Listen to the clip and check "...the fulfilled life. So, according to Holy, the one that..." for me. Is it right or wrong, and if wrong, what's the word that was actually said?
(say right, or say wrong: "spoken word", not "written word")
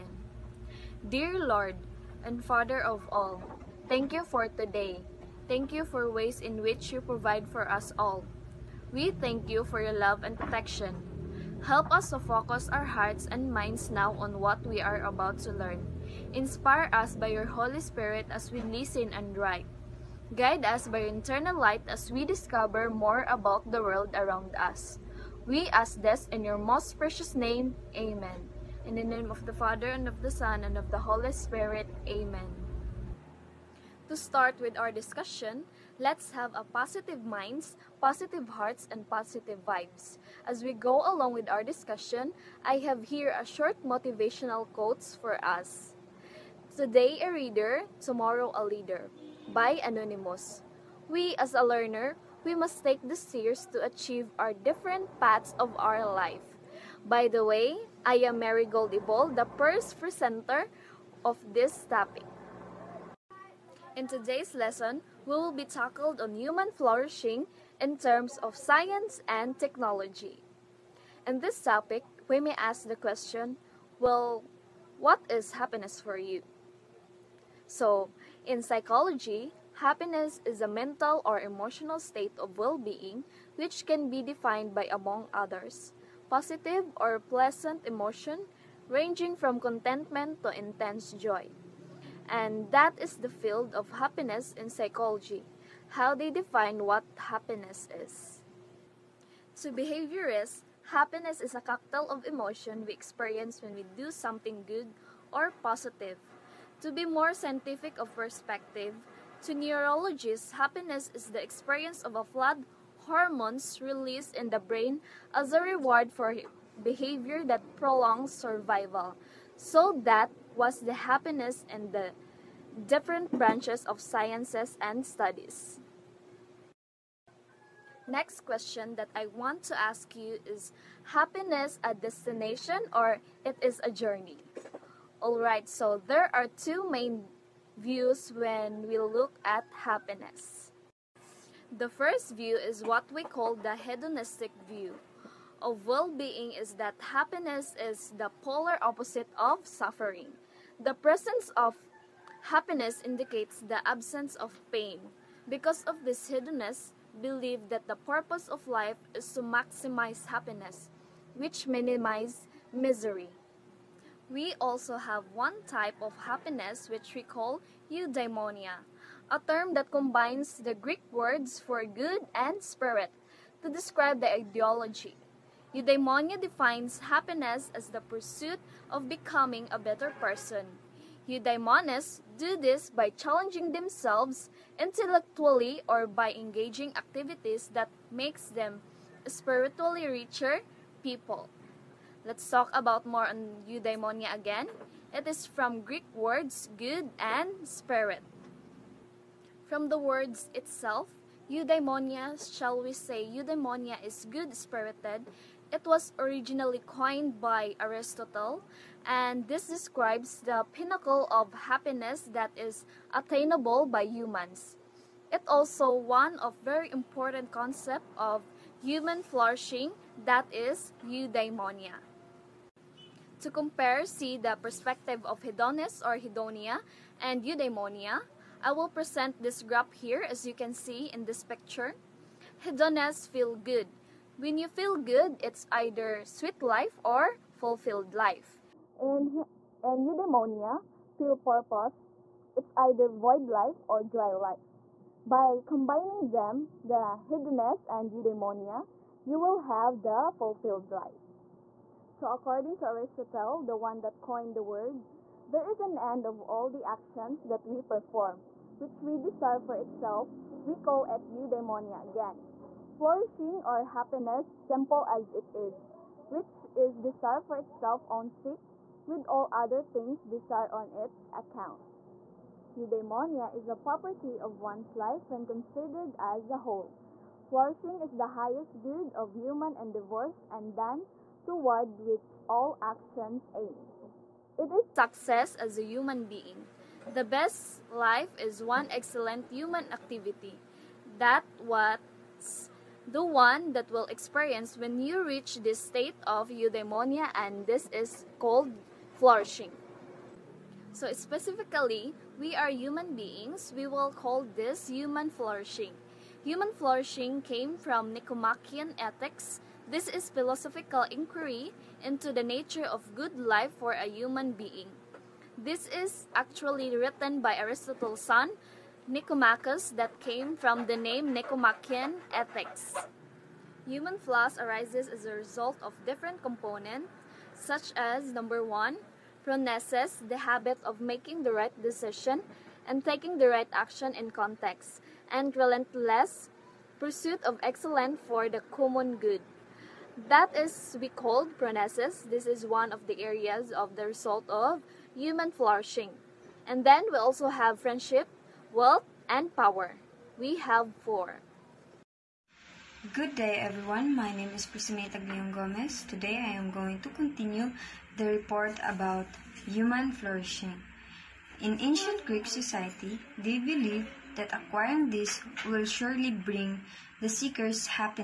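wrong: "Aristotle", not "Holy".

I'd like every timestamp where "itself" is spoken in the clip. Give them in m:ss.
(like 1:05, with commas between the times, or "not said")
3:20, 4:19, 4:27.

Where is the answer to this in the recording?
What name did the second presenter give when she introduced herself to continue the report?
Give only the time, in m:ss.
5:54.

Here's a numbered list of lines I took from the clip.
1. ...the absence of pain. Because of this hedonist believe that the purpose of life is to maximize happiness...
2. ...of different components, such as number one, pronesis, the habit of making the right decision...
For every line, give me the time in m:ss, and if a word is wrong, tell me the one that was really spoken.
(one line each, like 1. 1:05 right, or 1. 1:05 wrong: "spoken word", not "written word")
1. 2:33 right
2. 5:25 right.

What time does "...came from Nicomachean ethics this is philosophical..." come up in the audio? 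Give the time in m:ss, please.
5:07.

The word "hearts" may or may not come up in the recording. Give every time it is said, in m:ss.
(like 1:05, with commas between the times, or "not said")
0:12, 0:38.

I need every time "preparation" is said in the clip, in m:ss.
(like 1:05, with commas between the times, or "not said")
not said.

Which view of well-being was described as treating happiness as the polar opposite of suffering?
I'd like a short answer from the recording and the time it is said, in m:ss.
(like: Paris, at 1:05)
hedonistic view, at 2:23.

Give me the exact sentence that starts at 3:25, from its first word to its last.
It was originally coined by Aristotle, and this describes the pinnacle of happiness that is attainable by humans.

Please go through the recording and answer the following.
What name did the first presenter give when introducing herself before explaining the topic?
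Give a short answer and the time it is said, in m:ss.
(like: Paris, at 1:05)
Mary Goldiball, at 0:58.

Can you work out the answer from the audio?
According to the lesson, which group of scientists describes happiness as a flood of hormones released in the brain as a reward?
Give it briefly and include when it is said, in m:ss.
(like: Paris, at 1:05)
neurologists, at 1:49.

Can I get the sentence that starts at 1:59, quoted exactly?
So that was the happiness in the different branches of sciences and studies.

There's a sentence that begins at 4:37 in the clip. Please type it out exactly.
Flourishing is the highest good of human endeavors, and then toward which all actions aim.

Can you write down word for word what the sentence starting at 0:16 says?
Inspire us by your Holy Spirit as we listen and write.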